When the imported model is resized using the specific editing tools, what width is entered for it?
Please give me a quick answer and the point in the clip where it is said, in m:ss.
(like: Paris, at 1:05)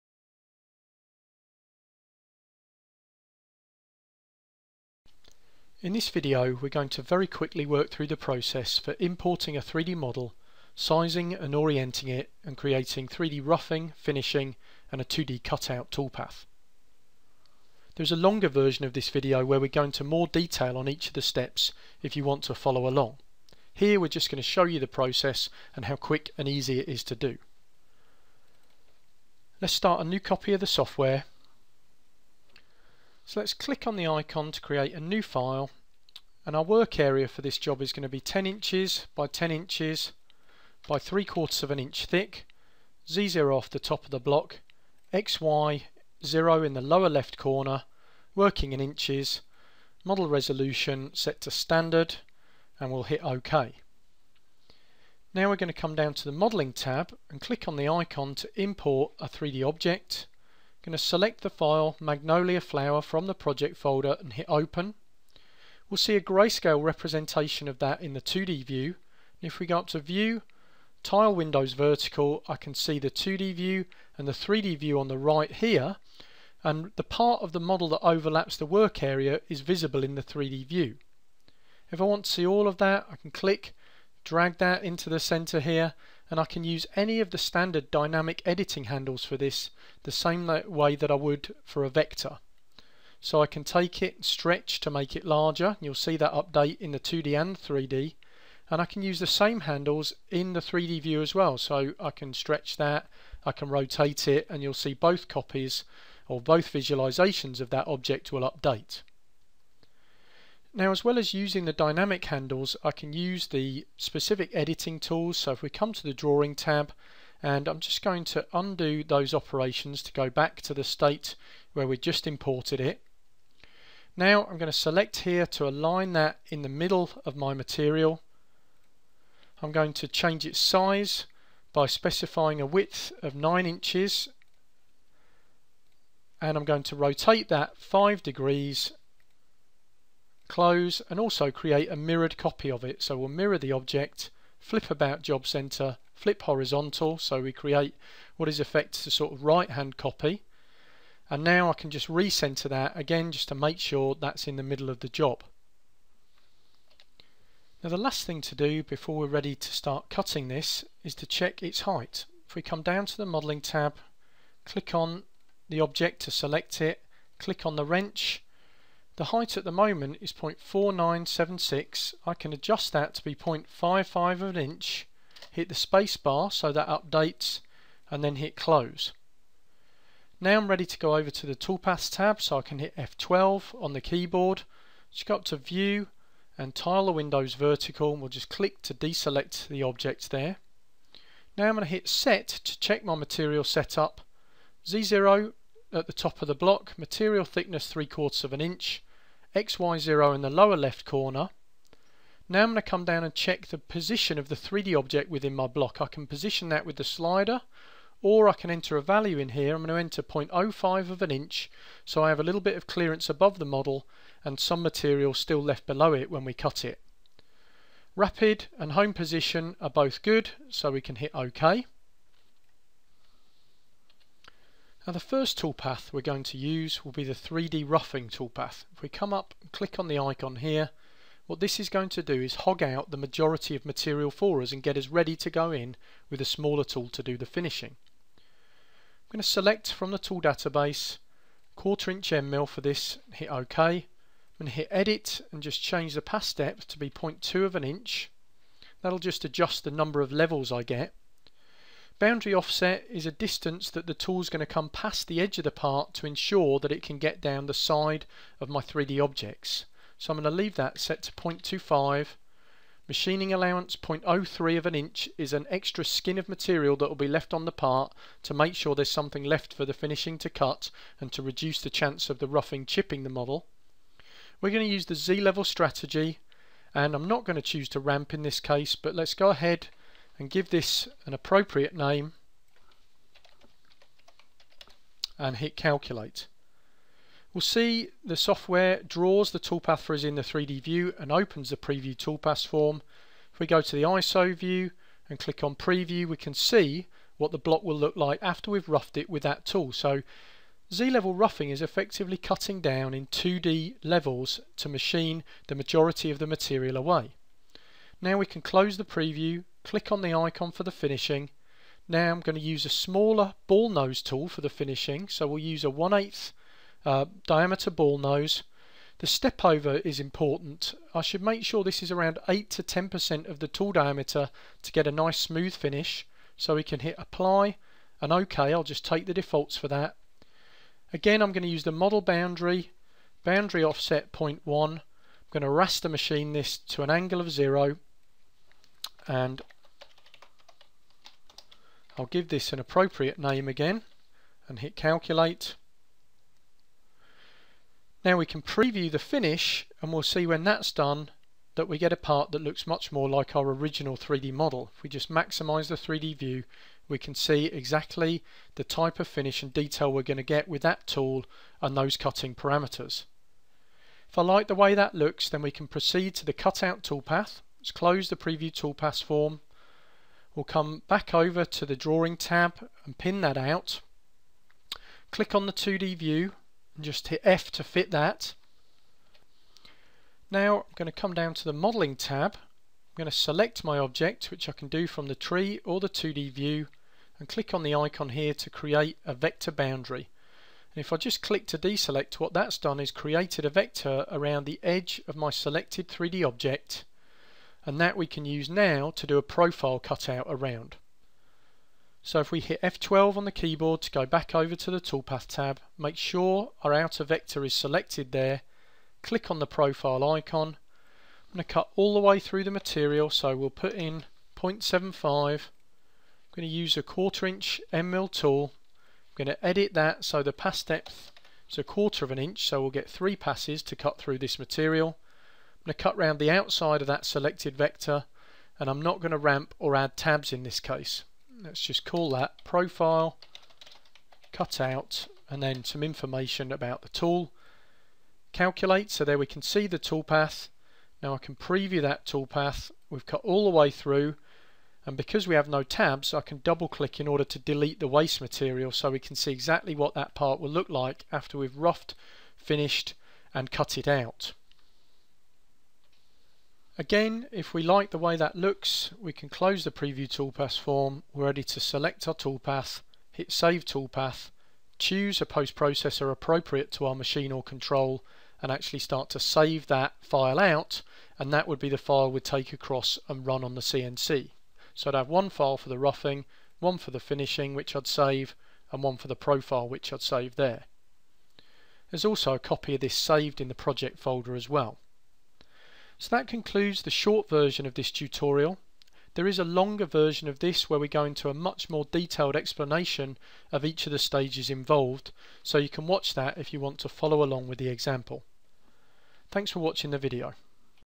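9 inches, at 2:13.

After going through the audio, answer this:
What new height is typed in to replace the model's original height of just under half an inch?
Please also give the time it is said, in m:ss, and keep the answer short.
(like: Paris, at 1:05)
0.55 inch, at 2:53.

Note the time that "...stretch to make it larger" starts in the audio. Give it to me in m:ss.
1:34.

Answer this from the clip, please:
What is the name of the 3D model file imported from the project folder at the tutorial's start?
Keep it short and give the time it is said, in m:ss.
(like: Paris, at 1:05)
Magnolia Flower, at 1:01.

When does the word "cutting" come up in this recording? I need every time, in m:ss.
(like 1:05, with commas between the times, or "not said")
2:40, 5:02, 6:02.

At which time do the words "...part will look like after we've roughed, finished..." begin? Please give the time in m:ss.
7:30.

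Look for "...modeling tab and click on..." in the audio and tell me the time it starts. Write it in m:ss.
0:56.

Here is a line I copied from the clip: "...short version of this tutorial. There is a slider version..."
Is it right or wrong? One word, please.
wrong.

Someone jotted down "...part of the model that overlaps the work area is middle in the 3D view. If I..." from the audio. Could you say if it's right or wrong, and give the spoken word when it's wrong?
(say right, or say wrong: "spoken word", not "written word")
wrong: "visible", not "middle".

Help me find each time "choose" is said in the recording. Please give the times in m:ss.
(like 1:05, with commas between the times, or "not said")
4:37, 7:44.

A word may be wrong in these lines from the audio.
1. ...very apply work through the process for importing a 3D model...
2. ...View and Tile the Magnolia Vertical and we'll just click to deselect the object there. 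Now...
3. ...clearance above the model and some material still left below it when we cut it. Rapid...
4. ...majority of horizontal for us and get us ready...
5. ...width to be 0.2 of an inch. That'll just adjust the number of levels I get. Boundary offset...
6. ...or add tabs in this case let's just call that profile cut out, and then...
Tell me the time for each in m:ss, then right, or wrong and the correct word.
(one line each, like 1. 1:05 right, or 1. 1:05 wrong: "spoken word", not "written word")
1. 0:07 wrong: "quickly", not "apply"
2. 3:05 wrong: "Windows", not "Magnolia"
3. 3:32 right
4. 3:53 wrong: "material", not "horizontal"
5. 4:06 wrong: "depth", not "width"
6. 7:09 right.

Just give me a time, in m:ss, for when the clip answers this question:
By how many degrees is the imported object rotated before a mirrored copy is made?
2:17.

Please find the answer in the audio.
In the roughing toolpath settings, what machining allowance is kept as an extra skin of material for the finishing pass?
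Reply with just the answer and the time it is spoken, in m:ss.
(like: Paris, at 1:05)
0.03 inch, at 4:23.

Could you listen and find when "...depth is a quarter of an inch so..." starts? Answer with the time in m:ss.
7:00.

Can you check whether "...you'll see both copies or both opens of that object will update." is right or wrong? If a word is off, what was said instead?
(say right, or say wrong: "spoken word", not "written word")
wrong: "visualizations", not "opens".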